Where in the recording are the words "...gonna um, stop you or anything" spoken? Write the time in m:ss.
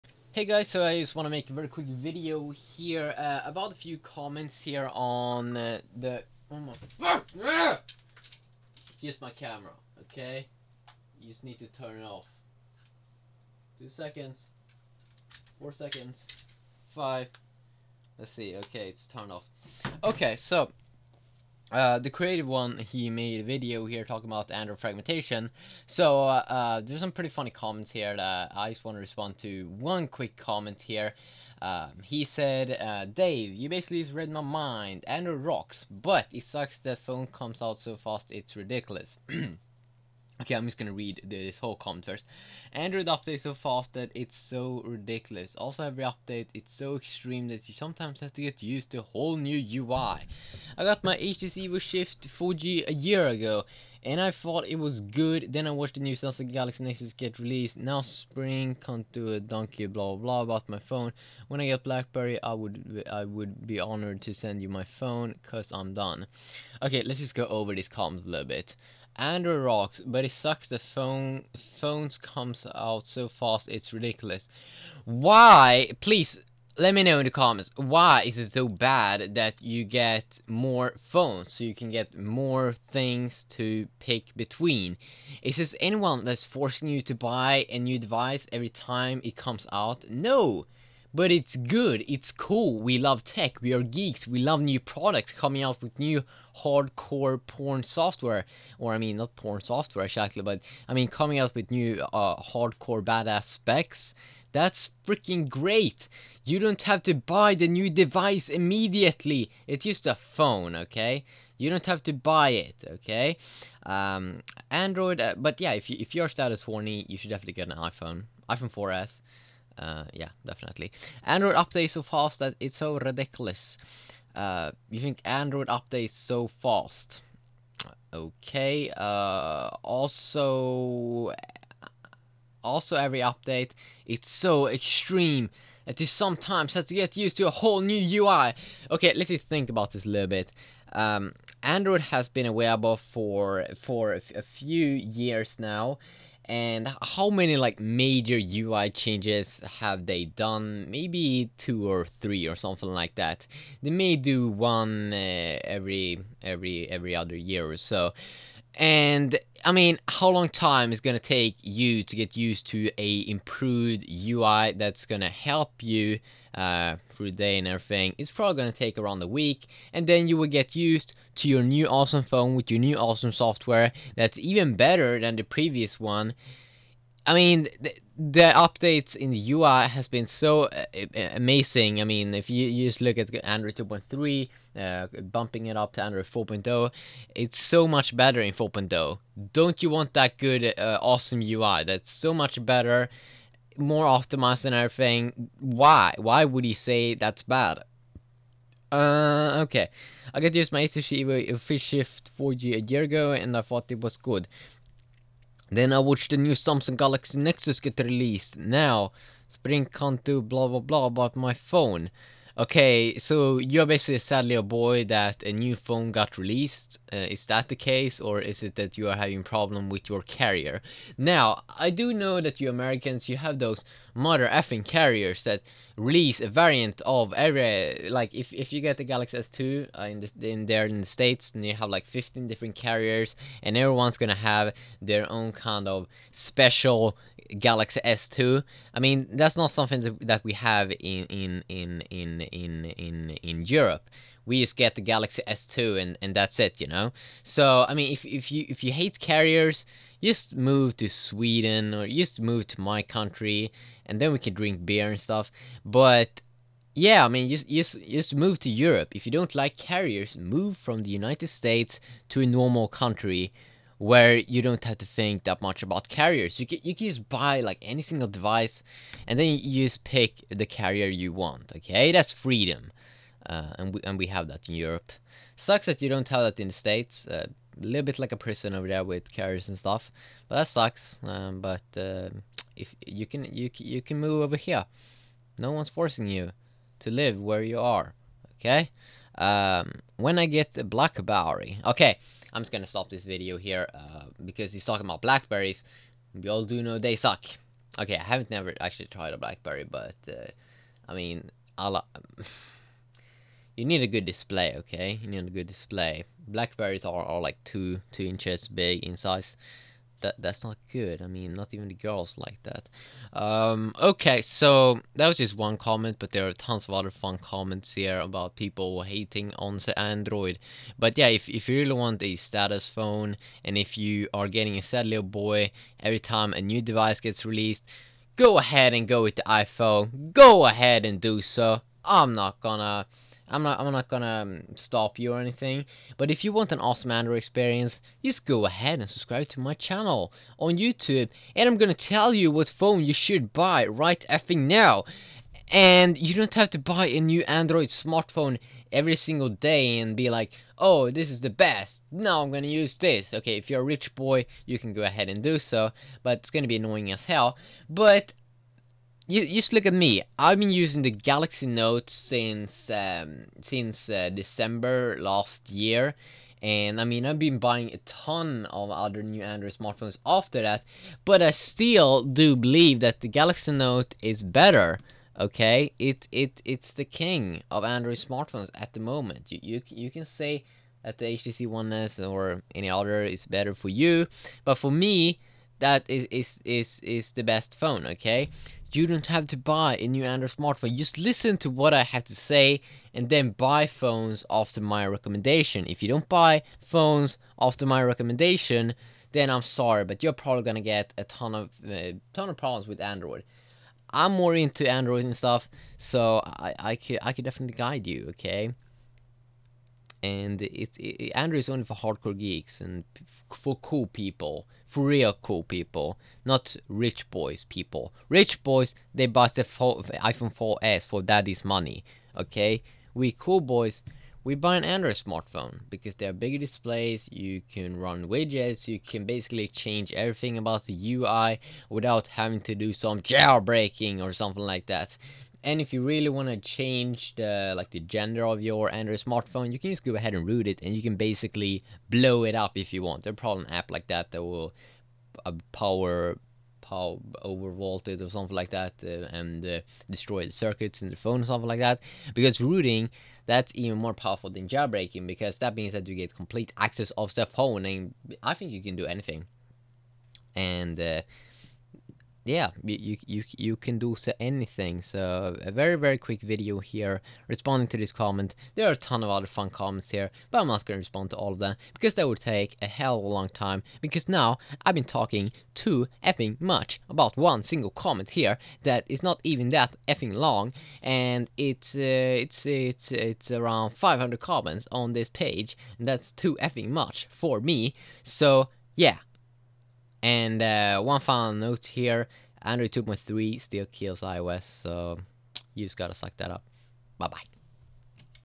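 5:34.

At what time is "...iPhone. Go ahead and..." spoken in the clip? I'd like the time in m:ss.
5:29.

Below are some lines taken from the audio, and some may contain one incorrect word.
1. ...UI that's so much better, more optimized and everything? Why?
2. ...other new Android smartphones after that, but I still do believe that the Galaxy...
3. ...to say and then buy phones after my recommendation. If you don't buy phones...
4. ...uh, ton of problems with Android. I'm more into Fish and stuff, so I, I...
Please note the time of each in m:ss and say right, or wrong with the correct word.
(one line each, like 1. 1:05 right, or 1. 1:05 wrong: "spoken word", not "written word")
1. 3:11 right
2. 6:08 right
3. 6:32 right
4. 6:41 wrong: "Android", not "Fish".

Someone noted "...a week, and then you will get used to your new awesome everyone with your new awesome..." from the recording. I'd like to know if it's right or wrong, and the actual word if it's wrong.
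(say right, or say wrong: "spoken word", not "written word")
wrong: "phone", not "everyone".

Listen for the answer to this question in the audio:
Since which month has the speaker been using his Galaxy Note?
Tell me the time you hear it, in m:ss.
6:04.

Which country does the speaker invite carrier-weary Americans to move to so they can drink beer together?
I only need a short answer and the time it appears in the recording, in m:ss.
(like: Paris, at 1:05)
Sweden, at 4:11.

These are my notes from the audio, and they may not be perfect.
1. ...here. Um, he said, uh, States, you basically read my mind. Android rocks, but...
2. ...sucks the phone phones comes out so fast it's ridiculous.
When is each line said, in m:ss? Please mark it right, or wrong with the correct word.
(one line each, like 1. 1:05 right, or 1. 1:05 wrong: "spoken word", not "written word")
1. 0:30 wrong: "Dave", not "States"
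2. 1:10 right.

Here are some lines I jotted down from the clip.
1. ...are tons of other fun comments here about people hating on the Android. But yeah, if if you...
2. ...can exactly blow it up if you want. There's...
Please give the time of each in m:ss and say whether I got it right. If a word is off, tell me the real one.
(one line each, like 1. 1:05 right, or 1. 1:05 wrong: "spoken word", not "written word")
1. 5:16 right
2. 7:21 wrong: "basically", not "exactly".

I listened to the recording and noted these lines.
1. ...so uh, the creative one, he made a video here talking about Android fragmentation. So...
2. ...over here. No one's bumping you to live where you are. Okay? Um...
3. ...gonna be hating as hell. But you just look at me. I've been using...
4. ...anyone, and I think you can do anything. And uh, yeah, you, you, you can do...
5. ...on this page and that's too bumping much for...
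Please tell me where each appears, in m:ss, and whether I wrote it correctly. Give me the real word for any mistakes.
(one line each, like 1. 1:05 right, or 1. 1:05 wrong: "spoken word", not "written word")
1. 0:20 right
2. 4:44 wrong: "forcing", not "bumping"
3. 5:56 wrong: "annoying", not "hating"
4. 7:37 wrong: "phone", not "anyone"
5. 8:04 wrong: "effing", not "bumping".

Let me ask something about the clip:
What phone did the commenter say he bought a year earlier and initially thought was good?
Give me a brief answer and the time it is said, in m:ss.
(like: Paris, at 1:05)
HTC Evo Shift 4G, at 0:51.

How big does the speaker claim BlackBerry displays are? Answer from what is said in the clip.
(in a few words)
2 inches.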